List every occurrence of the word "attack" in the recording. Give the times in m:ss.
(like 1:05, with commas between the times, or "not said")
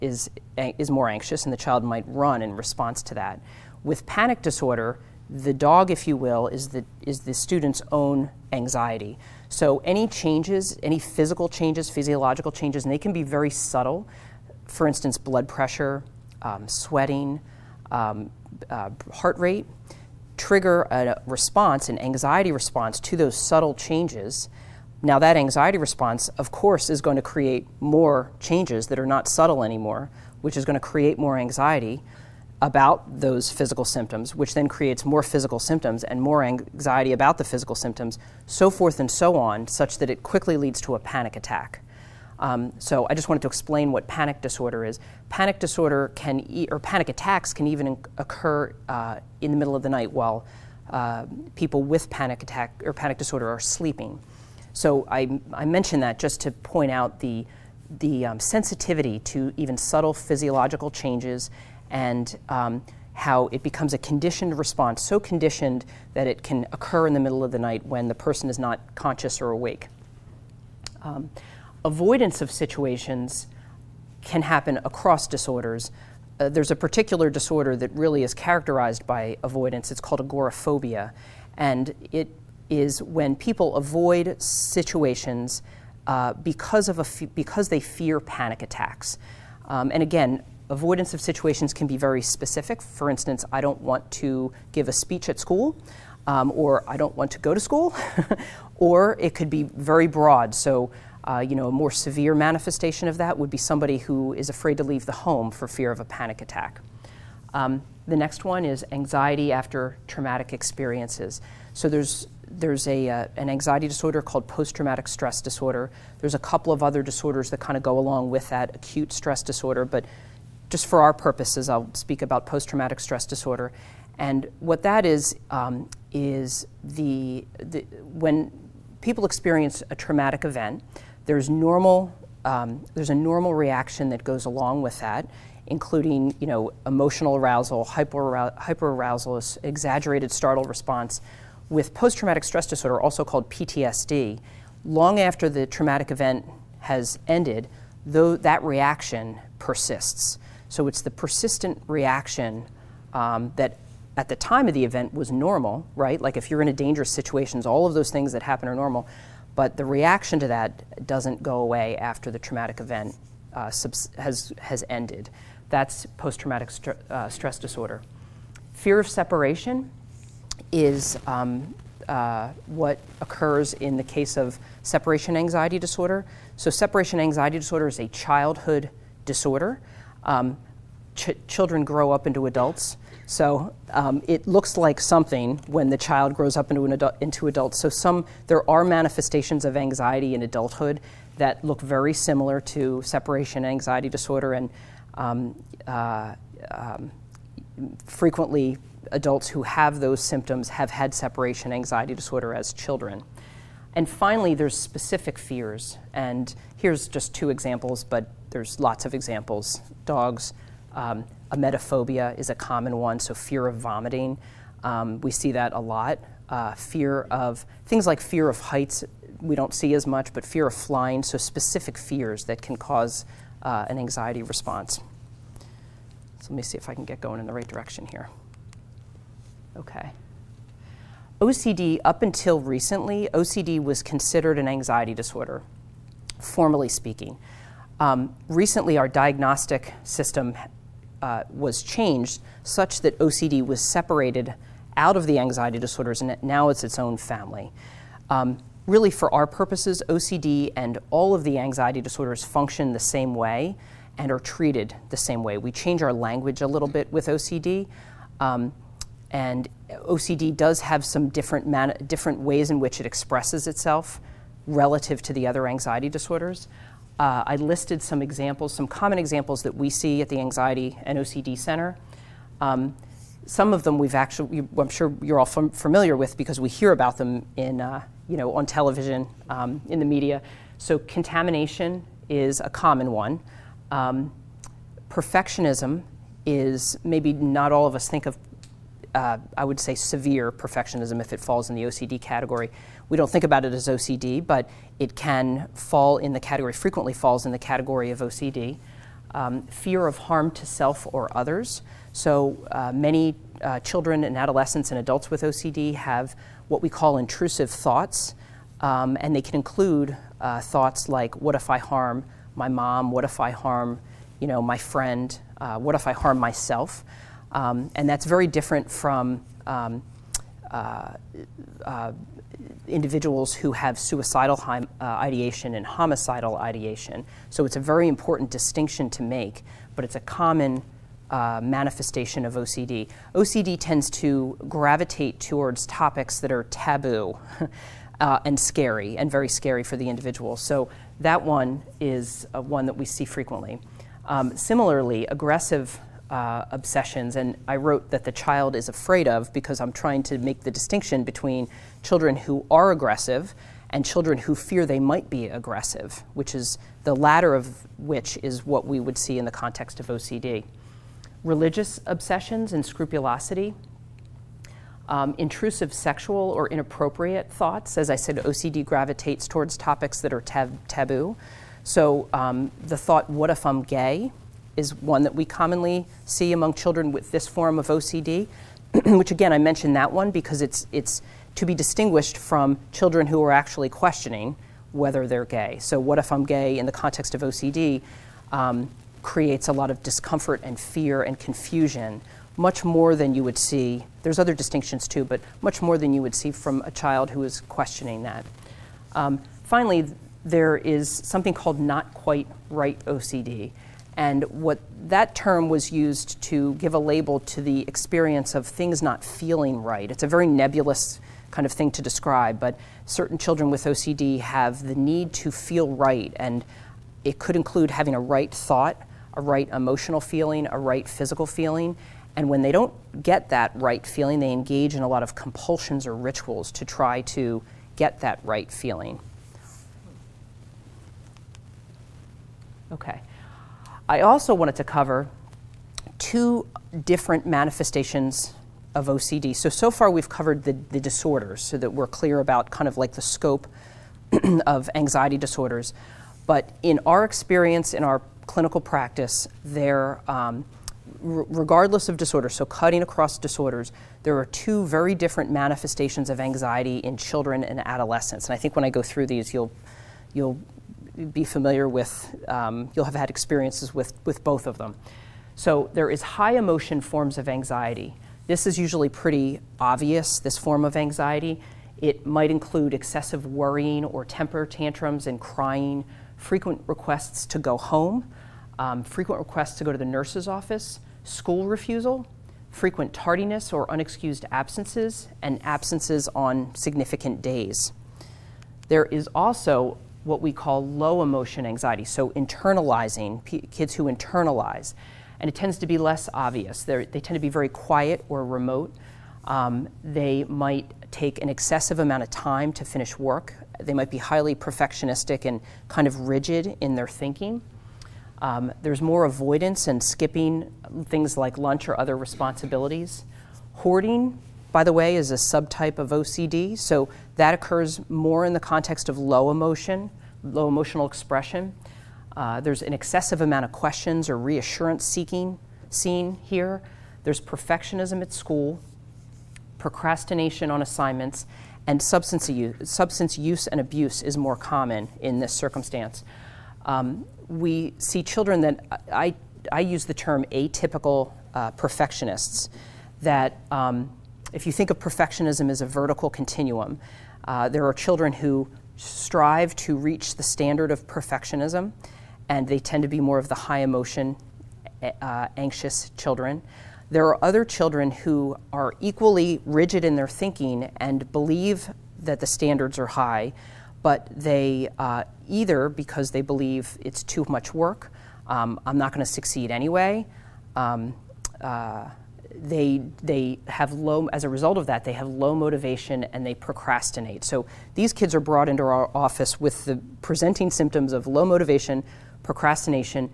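0:41, 0:47, 0:52, 1:28, 1:46.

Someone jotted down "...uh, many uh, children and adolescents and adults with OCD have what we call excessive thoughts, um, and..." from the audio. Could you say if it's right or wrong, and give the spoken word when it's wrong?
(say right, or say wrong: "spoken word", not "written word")
wrong: "intrusive", not "excessive".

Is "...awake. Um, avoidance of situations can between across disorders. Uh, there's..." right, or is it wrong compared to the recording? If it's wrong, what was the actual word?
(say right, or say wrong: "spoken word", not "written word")
wrong: "happen", not "between".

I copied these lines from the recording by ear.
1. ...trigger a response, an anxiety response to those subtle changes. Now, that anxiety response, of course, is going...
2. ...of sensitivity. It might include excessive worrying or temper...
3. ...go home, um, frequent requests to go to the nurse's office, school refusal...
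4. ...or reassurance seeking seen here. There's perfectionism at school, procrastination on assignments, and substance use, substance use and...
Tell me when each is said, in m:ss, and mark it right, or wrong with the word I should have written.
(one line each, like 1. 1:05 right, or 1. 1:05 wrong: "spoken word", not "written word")
1. 0:20 right
2. 7:50 wrong: "anxiety", not "sensitivity"
3. 7:57 right
4. 8:44 right.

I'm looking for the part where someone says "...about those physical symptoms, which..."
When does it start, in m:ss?
0:32.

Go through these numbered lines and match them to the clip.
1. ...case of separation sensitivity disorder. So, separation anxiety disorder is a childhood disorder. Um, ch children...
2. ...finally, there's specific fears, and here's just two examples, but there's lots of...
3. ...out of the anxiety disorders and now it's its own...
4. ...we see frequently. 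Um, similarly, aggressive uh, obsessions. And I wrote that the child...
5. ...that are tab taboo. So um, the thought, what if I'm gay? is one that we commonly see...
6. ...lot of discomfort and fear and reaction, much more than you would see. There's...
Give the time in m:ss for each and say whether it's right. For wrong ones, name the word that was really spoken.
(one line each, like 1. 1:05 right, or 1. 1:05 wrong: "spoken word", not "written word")
1. 2:54 wrong: "anxiety", not "sensitivity"
2. 3:24 right
3. 4:04 right
4. 5:42 right
5. 6:10 right
6. 6:29 wrong: "confusion", not "reaction".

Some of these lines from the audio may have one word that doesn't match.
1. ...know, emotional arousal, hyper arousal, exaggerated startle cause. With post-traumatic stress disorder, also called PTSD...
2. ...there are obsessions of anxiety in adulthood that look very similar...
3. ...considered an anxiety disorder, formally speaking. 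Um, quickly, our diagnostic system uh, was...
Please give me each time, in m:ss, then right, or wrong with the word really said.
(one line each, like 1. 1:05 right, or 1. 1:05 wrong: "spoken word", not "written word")
1. 2:16 wrong: "response", not "cause"
2. 3:08 wrong: "manifestations", not "obsessions"
3. 3:54 wrong: "recently", not "quickly".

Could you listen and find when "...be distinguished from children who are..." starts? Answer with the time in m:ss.
6:21.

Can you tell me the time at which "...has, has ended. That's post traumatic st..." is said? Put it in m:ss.
2:44.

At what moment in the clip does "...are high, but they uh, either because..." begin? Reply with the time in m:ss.
9:22.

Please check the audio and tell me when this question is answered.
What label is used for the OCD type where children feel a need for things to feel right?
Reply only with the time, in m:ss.
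6:41.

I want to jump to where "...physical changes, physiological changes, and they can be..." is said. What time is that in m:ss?
0:10.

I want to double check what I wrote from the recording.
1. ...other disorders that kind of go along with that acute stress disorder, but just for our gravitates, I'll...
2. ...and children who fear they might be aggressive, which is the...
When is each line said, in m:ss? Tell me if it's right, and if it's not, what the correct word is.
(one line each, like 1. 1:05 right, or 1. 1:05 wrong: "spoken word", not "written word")
1. 1:56 wrong: "purposes", not "gravitates"
2. 5:53 right.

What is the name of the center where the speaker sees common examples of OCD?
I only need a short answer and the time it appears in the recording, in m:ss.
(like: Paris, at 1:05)
Anxiety and OCD Center, at 4:30.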